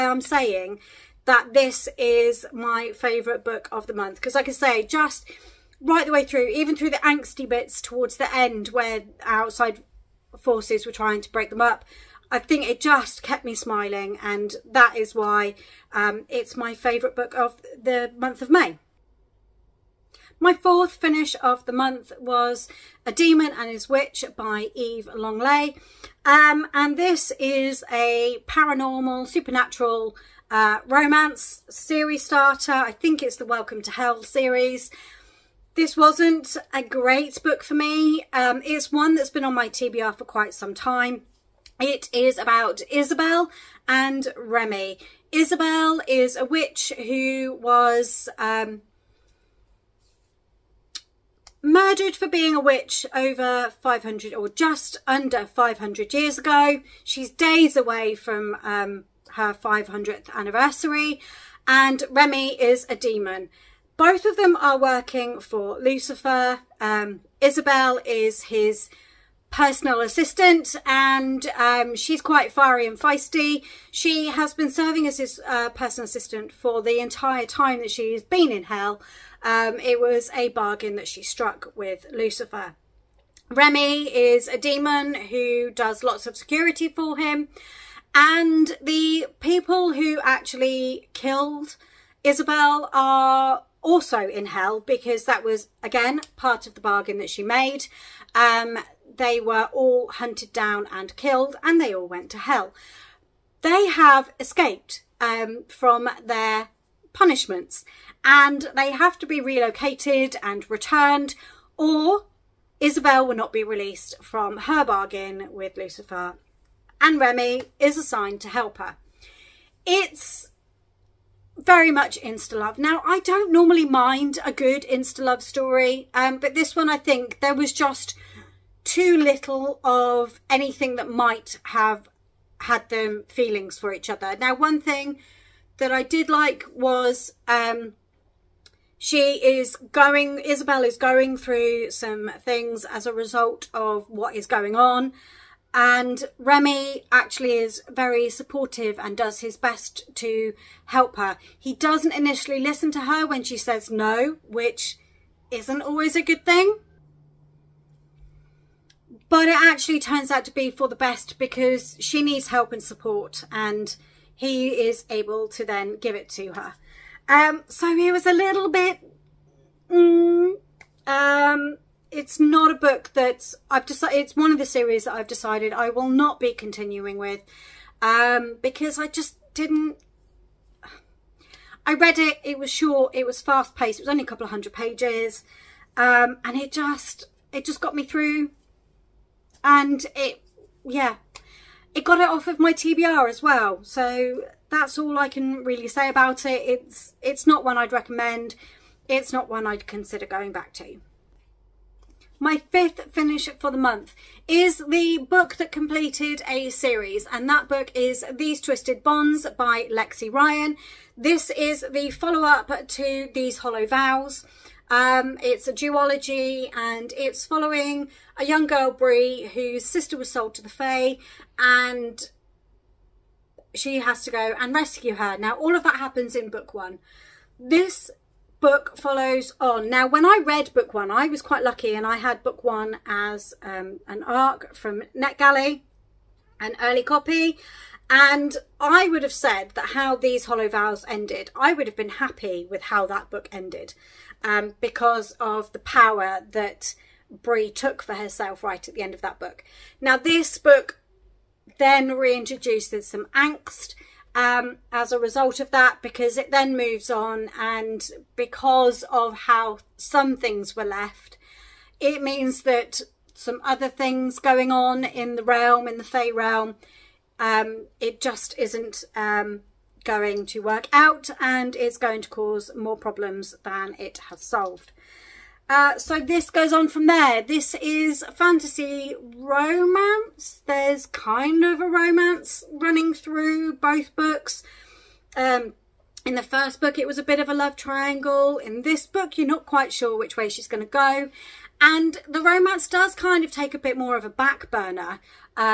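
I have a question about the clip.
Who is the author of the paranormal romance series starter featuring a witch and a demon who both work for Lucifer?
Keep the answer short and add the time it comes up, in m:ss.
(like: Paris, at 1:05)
Eve Langlais, at 0:24.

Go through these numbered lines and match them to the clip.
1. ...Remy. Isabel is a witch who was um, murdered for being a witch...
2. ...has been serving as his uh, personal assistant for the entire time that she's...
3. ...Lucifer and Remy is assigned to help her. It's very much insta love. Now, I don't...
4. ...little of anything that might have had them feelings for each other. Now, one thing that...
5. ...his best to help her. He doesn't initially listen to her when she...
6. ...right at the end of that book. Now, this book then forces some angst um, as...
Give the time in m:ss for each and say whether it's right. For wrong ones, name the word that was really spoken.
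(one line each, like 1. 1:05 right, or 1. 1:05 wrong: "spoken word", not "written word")
1. 0:44 right
2. 1:14 right
3. 1:55 right
4. 2:09 right
5. 2:29 right
6. 4:08 wrong: "reintroduces", not "forces".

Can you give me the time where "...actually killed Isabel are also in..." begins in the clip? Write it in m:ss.
1:30.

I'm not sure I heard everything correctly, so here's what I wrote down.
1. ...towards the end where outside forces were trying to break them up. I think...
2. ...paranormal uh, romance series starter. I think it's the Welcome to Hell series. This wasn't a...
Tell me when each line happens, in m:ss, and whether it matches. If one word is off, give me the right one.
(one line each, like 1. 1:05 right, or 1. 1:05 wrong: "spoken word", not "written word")
1. 0:07 right
2. 0:29 wrong: "supernatural", not "paranormal".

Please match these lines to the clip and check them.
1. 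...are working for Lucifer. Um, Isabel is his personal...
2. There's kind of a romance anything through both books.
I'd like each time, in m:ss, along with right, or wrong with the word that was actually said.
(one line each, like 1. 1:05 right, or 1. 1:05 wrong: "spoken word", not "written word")
1. 1:04 right
2. 4:40 wrong: "running", not "anything".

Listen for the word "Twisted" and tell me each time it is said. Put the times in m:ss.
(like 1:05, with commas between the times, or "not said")
3:28.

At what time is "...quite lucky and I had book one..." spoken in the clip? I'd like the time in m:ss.
3:51.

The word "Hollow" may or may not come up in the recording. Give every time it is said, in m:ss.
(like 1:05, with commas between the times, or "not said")
3:33, 4:00.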